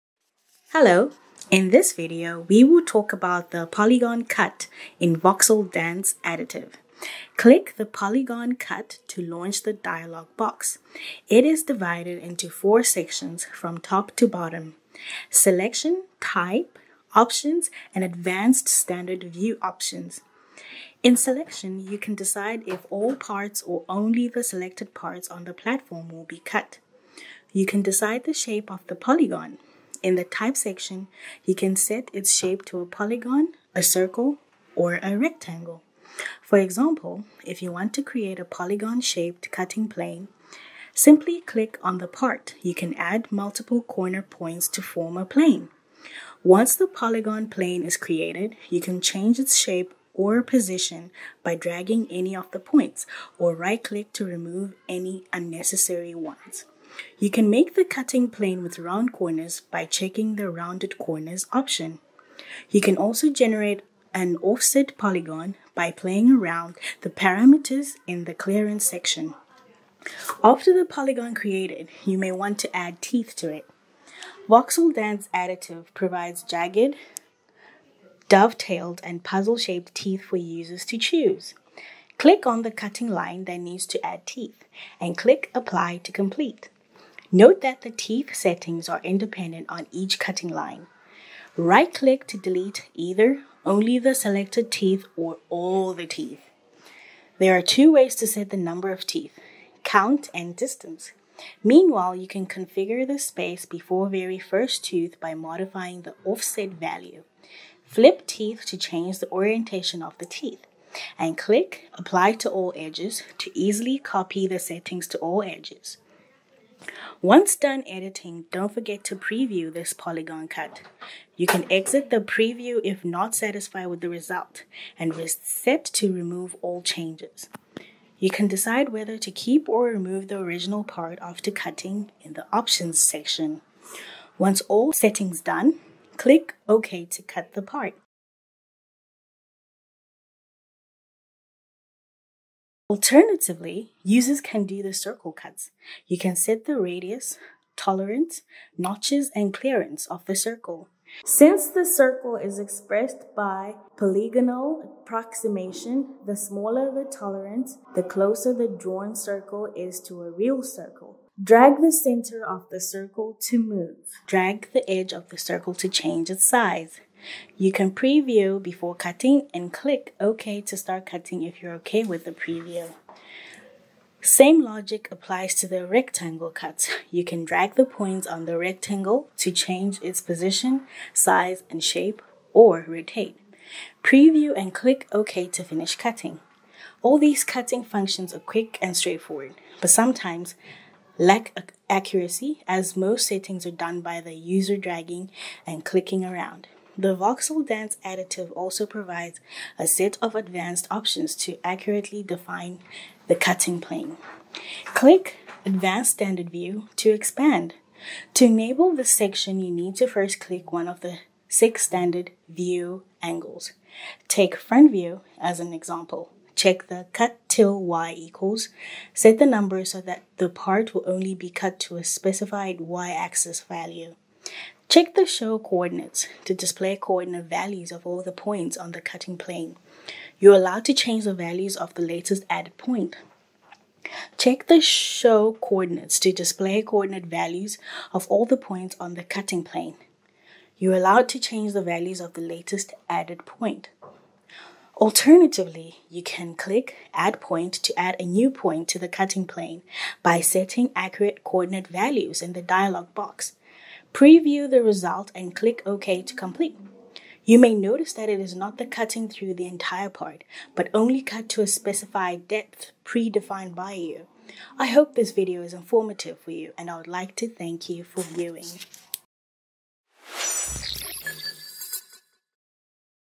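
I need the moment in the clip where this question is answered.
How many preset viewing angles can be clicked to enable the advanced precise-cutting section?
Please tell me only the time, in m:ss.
3:31.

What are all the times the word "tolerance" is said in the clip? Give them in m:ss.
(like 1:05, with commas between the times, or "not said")
2:27, 2:37.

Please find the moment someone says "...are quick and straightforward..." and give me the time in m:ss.
3:08.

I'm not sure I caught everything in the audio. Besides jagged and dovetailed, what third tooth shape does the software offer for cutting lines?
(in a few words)
Puzzle-shaped.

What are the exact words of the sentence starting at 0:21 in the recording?
In selection, you can decide if all parts or only the selected parts on the platform will be cut.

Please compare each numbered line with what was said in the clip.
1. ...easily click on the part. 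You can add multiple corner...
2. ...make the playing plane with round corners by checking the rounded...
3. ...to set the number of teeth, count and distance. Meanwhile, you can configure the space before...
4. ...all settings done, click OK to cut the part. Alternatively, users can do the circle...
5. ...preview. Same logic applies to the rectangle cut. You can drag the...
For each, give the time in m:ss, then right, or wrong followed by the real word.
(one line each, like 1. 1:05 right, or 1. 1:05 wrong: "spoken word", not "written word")
1. 0:40 wrong: "simply", not "easily"
2. 0:57 wrong: "cutting", not "playing"
3. 1:38 right
4. 2:14 right
5. 2:52 right.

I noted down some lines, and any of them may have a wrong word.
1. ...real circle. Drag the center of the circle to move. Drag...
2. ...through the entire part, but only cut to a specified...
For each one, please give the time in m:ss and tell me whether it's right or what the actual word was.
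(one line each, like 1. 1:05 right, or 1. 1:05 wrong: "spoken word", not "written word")
1. 2:40 right
2. 4:19 right.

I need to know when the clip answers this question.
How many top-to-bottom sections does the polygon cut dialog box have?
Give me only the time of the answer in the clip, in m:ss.
0:12.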